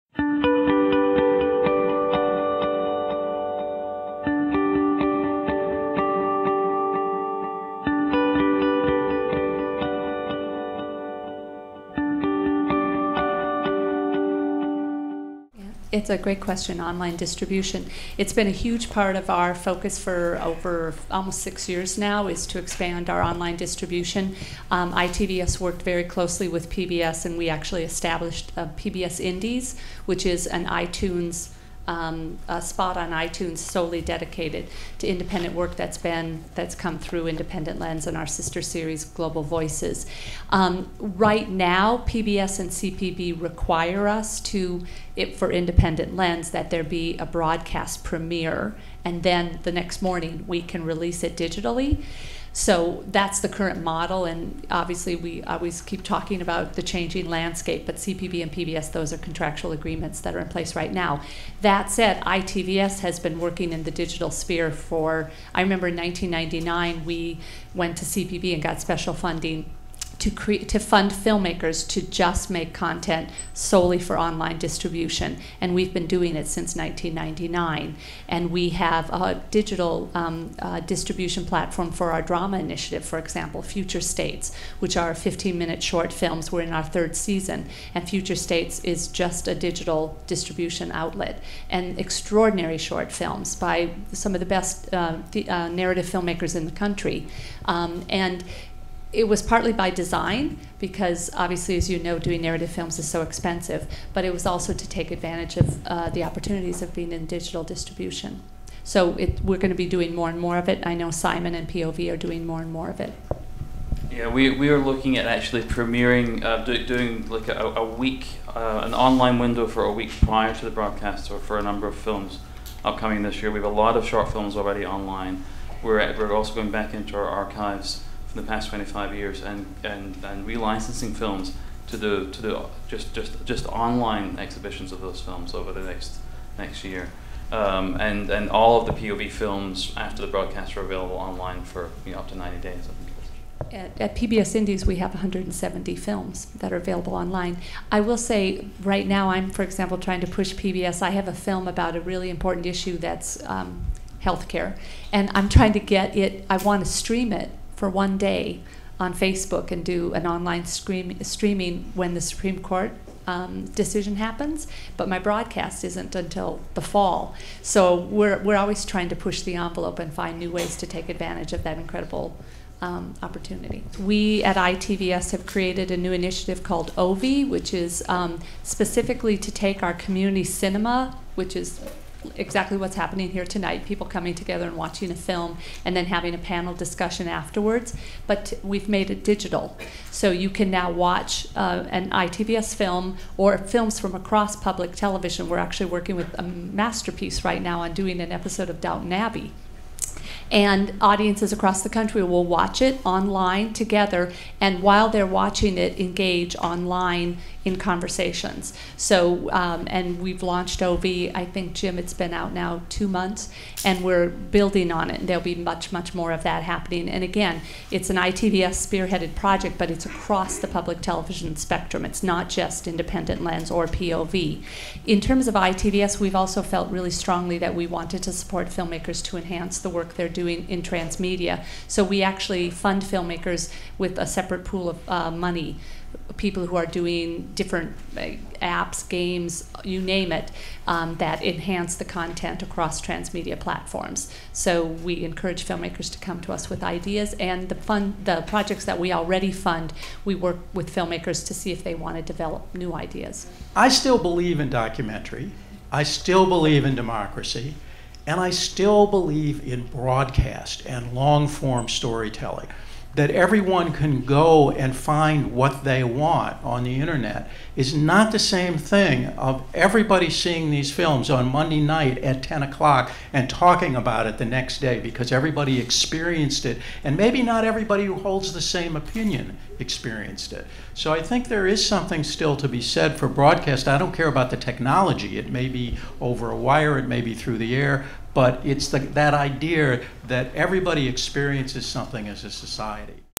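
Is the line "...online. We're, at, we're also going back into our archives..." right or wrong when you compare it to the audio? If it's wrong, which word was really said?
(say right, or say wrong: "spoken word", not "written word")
right.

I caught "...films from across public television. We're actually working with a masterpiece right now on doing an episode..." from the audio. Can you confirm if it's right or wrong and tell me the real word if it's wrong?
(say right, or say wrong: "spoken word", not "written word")
right.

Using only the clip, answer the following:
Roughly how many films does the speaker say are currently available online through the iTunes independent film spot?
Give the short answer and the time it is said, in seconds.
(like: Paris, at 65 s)
170, at 145 s.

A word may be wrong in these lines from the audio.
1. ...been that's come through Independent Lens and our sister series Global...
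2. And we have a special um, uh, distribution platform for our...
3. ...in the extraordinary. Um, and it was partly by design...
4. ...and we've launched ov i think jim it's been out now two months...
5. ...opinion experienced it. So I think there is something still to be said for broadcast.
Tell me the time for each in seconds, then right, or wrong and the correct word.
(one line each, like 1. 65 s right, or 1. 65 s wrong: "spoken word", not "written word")
1. 35 s right
2. 78 s wrong: "digital", not "special"
3. 96 s wrong: "country", not "extraordinary"
4. 209 s right
5. 278 s right.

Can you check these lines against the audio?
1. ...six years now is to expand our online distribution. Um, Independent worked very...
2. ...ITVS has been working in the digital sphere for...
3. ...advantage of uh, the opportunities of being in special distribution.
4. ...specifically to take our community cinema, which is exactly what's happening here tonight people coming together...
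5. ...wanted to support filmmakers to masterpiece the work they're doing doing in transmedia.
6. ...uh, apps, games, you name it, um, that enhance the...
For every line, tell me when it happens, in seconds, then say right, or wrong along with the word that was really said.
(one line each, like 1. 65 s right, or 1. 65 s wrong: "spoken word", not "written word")
1. 21 s wrong: "ITVS", not "Independent"
2. 62 s right
3. 105 s wrong: "digital", not "special"
4. 178 s right
5. 227 s wrong: "enhance", not "masterpiece"
6. 238 s right.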